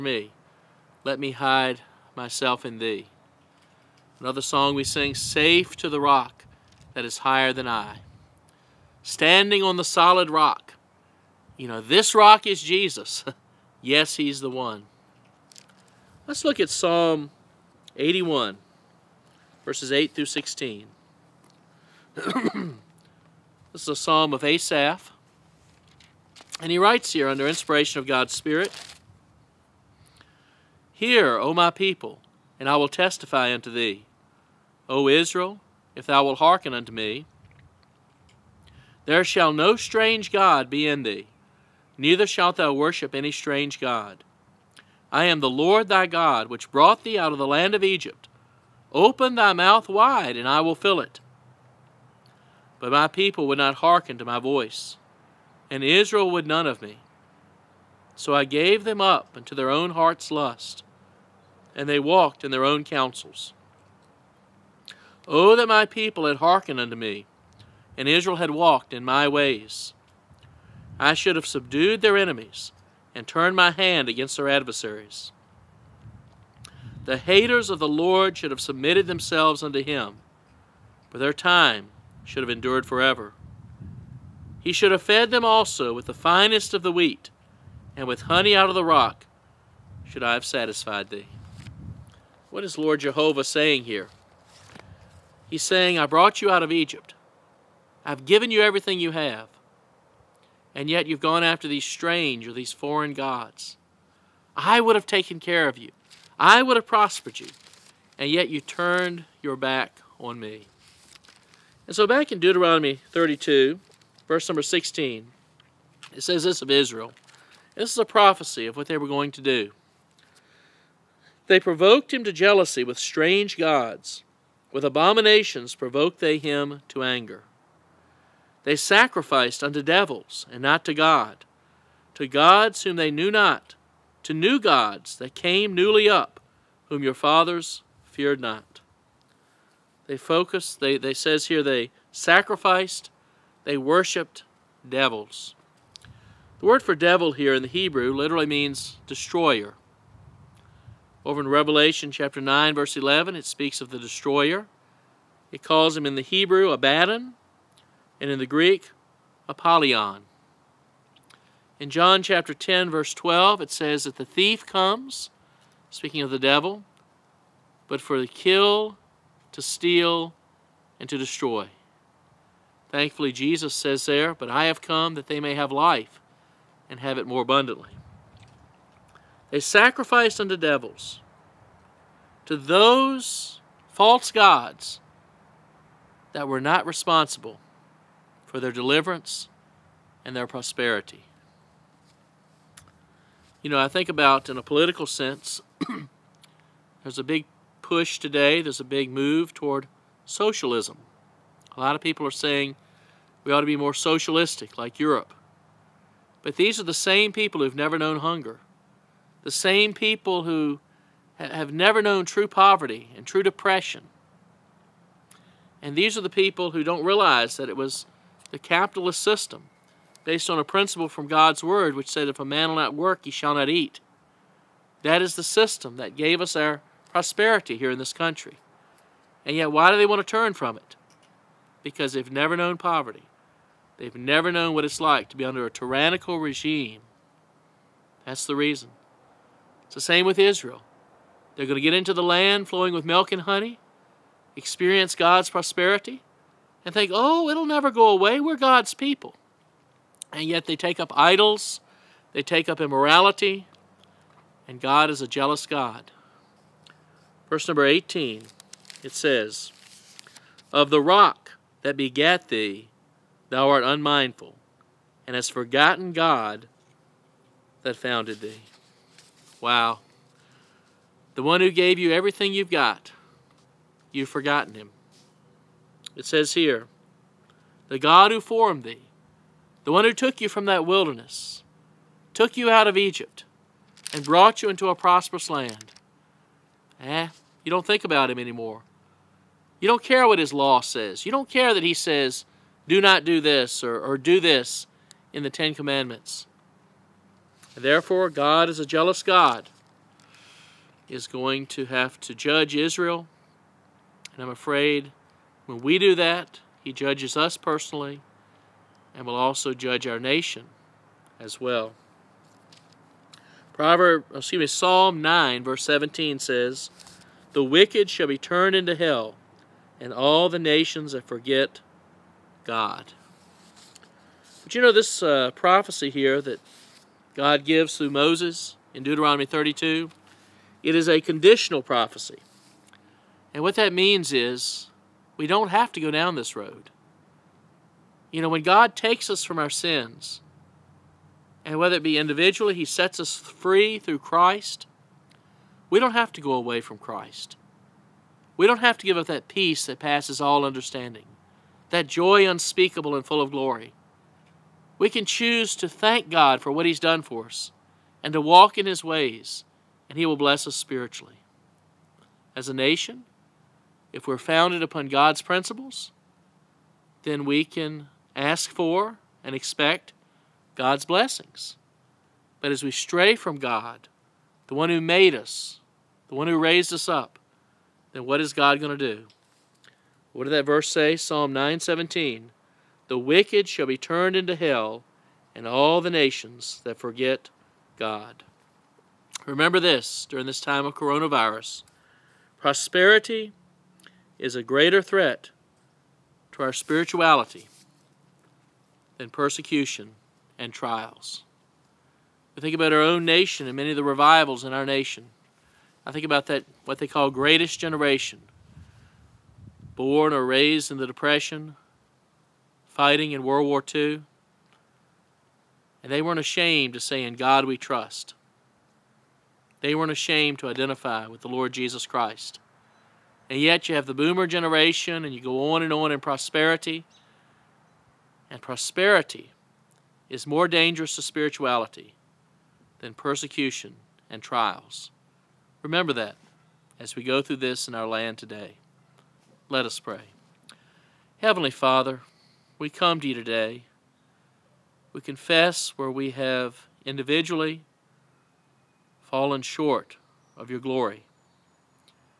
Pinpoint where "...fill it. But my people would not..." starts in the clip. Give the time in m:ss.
0:50.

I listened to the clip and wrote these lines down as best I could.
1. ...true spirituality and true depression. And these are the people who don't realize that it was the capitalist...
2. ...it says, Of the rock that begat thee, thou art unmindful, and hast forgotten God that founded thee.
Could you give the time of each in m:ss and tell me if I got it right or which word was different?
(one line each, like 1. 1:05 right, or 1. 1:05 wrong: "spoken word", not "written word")
1. 3:32 wrong: "poverty", not "spirituality"
2. 4:19 right.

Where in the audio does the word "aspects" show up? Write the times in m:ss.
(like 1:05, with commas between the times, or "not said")
not said.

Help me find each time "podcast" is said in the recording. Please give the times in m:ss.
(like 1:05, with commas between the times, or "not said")
not said.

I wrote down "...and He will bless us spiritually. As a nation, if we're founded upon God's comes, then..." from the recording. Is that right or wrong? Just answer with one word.
wrong.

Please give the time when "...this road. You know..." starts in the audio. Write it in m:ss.
5:36.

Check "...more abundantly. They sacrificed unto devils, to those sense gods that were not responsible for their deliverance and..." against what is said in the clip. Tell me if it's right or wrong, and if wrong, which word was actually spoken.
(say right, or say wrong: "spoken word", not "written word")
wrong: "false", not "sense".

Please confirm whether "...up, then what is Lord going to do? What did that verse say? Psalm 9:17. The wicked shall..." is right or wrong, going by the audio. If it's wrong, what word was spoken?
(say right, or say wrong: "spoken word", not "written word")
wrong: "God", not "Lord".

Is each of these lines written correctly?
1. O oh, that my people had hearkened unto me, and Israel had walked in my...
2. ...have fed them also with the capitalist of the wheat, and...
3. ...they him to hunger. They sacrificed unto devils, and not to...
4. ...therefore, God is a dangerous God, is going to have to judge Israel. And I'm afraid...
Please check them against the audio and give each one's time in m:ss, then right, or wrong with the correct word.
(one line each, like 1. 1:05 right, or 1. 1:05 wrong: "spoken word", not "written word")
1. 1:04 right
2. 1:24 wrong: "finest", not "capitalist"
3. 2:06 wrong: "anger", not "hunger"
4. 4:57 wrong: "jealous", not "dangerous".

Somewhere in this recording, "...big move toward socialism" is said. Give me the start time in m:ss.
3:18.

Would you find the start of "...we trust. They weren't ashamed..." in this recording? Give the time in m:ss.
6:57.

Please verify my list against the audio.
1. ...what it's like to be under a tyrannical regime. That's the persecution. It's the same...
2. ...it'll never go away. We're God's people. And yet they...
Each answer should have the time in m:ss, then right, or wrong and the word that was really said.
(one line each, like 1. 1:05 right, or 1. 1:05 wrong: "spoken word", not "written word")
1. 3:54 wrong: "reason", not "persecution"
2. 4:07 right.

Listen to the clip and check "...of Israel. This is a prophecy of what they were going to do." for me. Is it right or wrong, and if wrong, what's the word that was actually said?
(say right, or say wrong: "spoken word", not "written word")
right.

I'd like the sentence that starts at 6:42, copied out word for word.
We think about our own nation and many of the revivals in our nation.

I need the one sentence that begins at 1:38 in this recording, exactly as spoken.
I've given you everything you have.